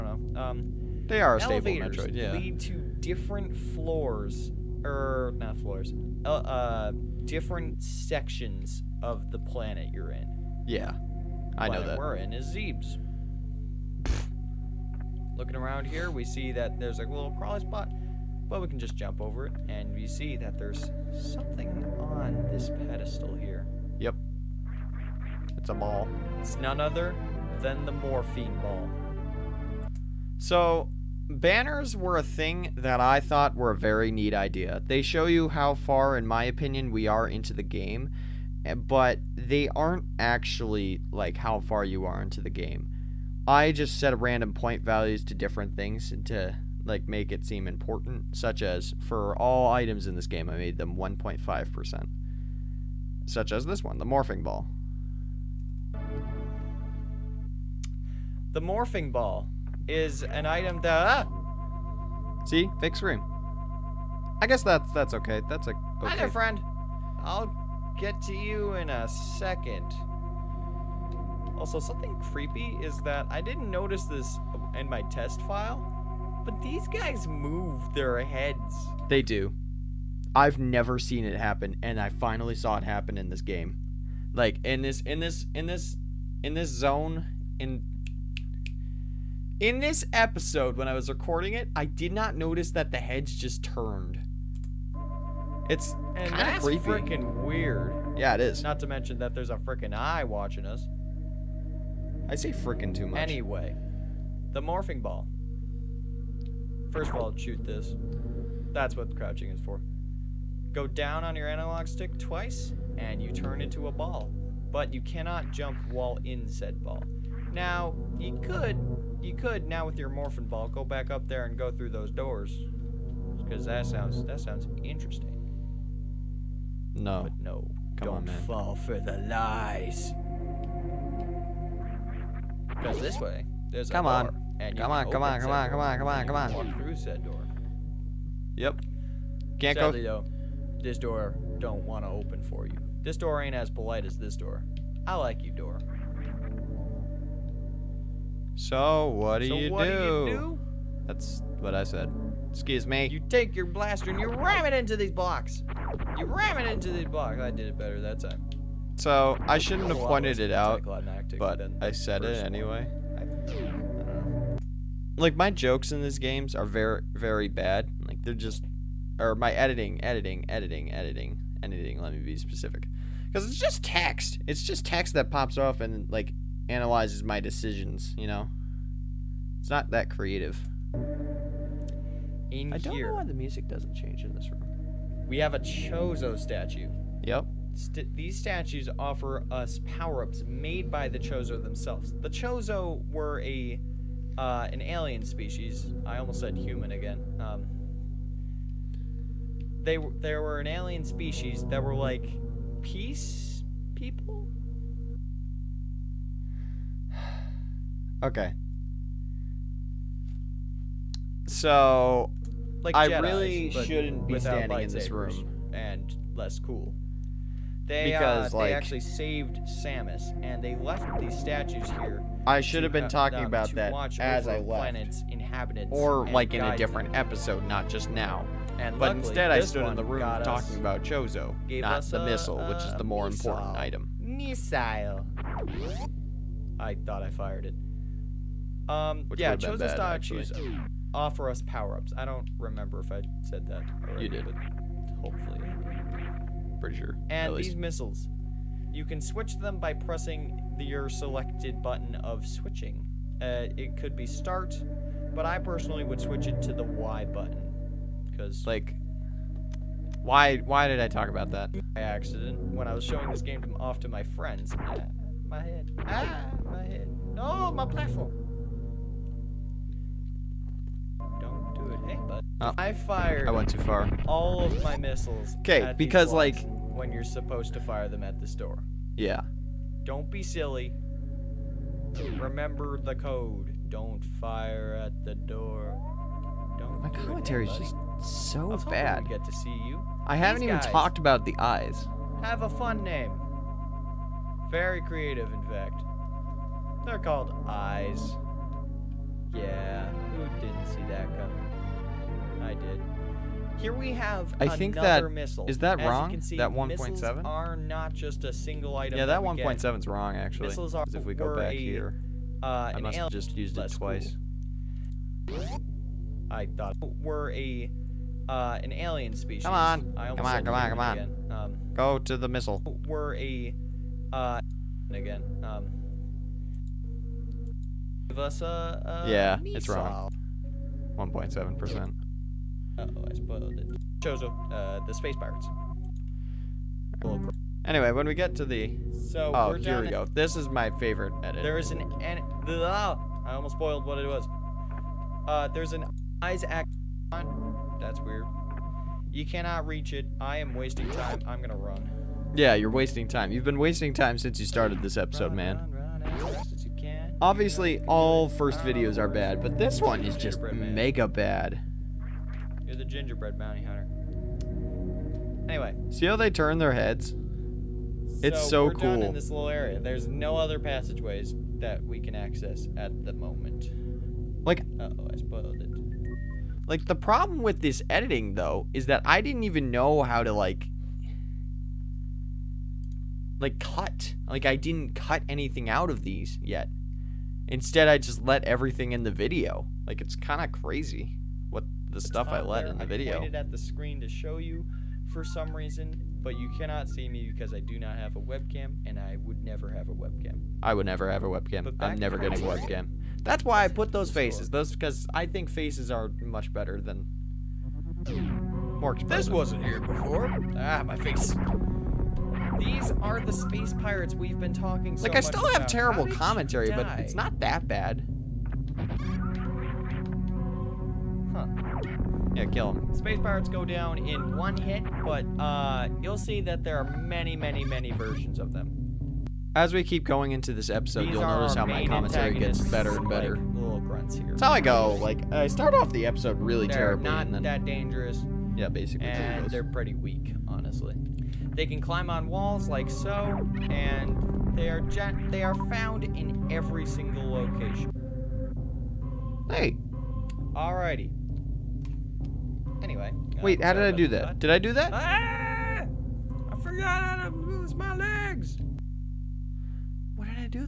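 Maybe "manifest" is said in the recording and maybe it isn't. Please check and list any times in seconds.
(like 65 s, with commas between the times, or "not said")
not said.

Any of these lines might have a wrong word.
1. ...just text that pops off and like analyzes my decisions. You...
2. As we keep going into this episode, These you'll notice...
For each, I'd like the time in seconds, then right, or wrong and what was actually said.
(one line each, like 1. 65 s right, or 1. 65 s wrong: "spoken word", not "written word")
1. 174 s right
2. 429 s right.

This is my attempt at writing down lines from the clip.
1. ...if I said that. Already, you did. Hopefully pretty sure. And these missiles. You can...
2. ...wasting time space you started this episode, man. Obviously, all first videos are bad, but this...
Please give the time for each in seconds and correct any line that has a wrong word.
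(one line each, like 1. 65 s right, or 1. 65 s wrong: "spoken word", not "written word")
1. 243 s right
2. 353 s wrong: "since", not "space".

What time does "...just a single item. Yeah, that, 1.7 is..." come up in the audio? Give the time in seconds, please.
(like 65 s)
308 s.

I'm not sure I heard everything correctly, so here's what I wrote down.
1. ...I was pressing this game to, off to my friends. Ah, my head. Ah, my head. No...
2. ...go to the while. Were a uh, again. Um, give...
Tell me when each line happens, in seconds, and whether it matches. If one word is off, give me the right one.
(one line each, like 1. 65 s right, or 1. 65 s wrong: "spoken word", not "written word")
1. 262 s wrong: "showing", not "pressing"
2. 321 s wrong: "missile", not "while".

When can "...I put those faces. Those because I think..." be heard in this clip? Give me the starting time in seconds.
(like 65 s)
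403 s.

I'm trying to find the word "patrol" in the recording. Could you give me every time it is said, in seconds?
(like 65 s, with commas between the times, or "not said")
not said.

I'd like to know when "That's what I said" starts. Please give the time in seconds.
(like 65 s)
151 s.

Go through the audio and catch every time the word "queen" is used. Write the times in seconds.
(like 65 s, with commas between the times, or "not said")
not said.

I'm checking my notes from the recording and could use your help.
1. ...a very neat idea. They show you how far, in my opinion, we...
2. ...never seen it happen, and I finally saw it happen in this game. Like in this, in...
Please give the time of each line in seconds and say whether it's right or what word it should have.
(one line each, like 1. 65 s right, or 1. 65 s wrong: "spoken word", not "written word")
1. 33 s right
2. 80 s right.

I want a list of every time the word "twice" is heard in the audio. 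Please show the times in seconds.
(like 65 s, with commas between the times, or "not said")
112 s, 313 s.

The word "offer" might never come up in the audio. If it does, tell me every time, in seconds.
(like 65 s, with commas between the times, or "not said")
188 s, 241 s.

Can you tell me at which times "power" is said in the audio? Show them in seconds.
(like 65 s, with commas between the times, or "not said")
189 s, 241 s.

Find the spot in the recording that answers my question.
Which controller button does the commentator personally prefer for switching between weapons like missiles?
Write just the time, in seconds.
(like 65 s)
256 s.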